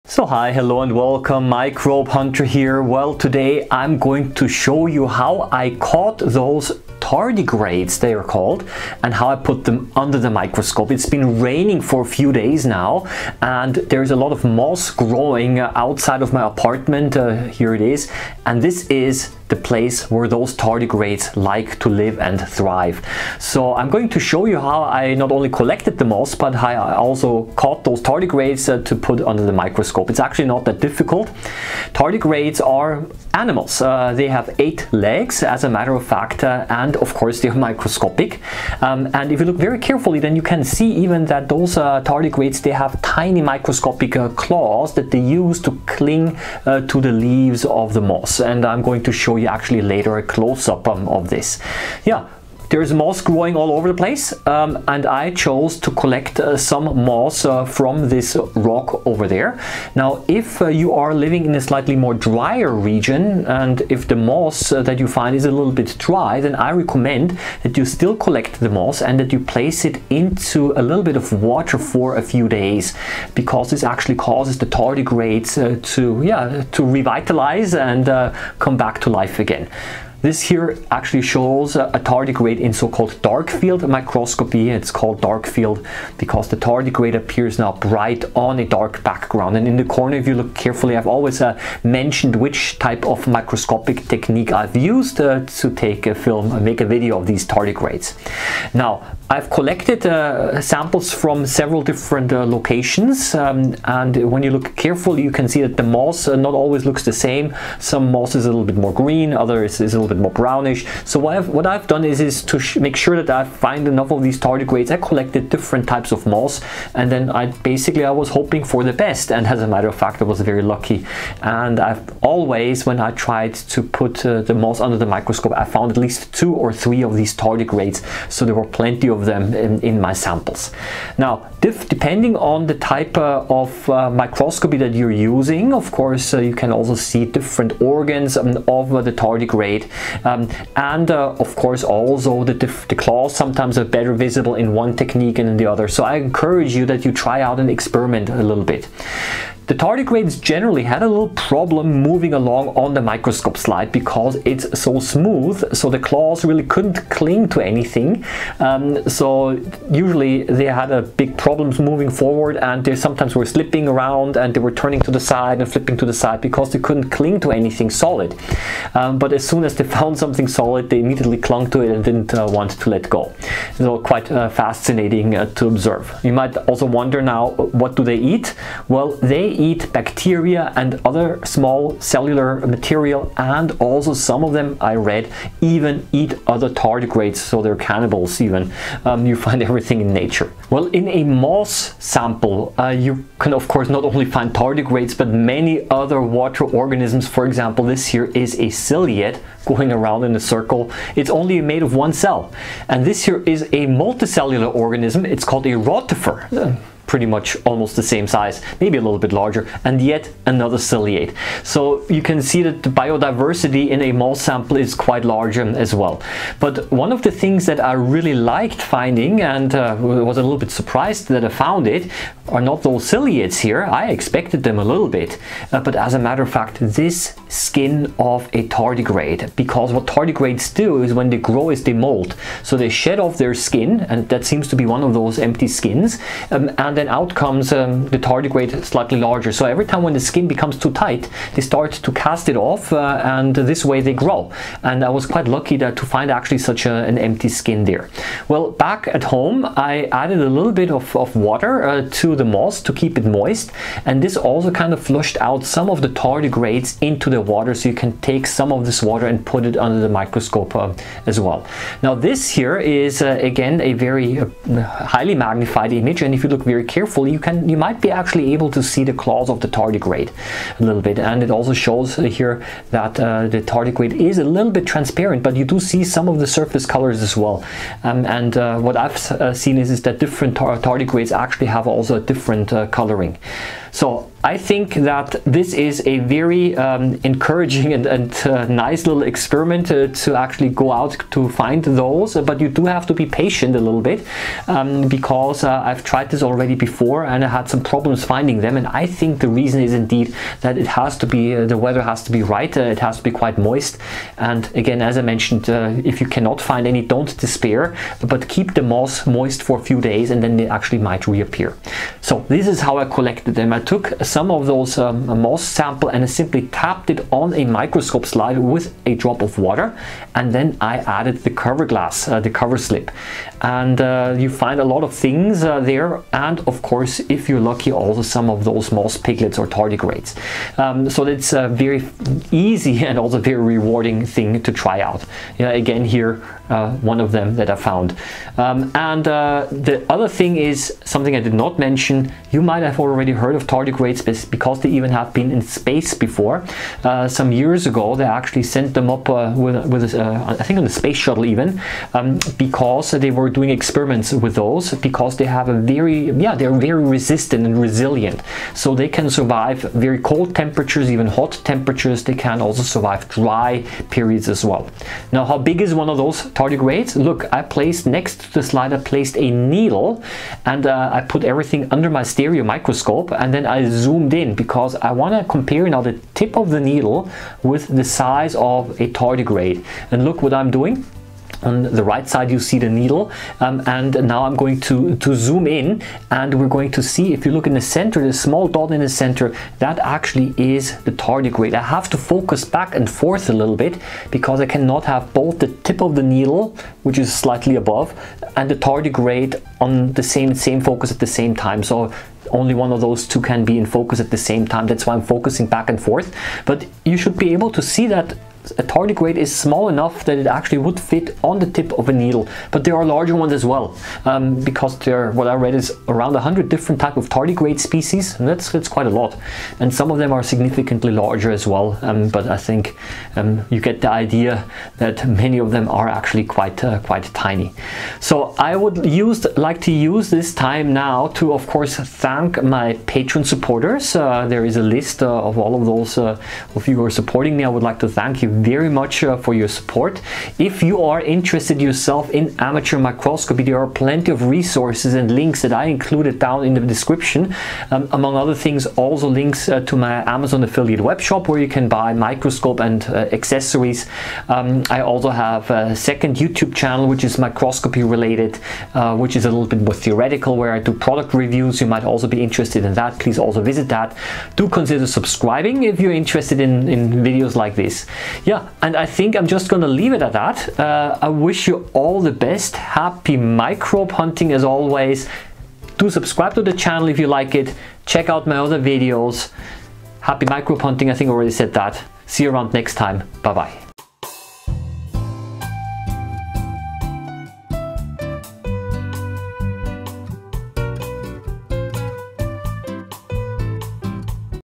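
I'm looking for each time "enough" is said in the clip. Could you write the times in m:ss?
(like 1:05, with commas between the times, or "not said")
1:53, 6:49.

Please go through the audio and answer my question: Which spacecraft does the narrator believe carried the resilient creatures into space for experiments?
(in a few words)
space shuttle.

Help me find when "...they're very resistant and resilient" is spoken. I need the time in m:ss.
5:56.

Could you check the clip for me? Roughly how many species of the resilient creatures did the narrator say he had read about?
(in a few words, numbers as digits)
100.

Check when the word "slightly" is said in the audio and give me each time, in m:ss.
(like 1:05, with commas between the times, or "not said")
1:01, 3:58, 6:37.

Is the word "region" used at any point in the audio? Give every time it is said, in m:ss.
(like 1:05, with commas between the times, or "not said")
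1:02.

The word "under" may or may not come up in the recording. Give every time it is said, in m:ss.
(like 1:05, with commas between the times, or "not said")
0:09, 0:29, 2:04, 4:19, 6:11.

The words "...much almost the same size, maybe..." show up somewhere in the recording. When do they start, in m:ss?
3:27.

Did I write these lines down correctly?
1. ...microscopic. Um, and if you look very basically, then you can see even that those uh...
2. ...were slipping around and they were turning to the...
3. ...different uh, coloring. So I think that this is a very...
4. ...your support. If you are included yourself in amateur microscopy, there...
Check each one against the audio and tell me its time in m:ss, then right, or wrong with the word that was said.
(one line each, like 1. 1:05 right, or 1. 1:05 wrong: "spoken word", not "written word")
1. 0:37 wrong: "carefully", not "basically"
2. 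2:43 right
3. 4:42 right
4. 7:19 wrong: "interested", not "included".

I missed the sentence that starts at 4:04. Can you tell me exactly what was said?
And I was quite lucky that to find actually such a, an empty skin there.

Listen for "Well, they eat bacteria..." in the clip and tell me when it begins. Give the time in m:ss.
2:58.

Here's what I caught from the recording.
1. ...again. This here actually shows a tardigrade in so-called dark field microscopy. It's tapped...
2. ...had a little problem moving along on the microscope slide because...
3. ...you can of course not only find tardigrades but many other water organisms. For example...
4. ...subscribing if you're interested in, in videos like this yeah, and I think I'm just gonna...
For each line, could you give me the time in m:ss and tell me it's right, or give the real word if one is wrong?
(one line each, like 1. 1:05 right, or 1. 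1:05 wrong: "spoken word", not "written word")
1. 1:19 wrong: "called", not "tapped"
2. 2:30 right
3. 3:12 right
4. 7:45 right.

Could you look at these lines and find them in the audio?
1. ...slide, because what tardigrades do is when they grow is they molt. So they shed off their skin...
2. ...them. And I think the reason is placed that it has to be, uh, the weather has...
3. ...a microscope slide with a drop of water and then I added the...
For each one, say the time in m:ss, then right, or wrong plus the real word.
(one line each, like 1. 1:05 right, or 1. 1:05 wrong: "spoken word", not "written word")
1. 3:48 wrong: "tardigrade", not "slide"
2. 4:58 wrong: "indeed", not "placed"
3. 5:17 right.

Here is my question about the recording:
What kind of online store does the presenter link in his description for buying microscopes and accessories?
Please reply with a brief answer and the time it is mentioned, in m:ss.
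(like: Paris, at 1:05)
Amazon affiliate web shop, at 7:30.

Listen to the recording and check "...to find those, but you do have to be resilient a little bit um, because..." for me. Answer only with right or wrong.
wrong.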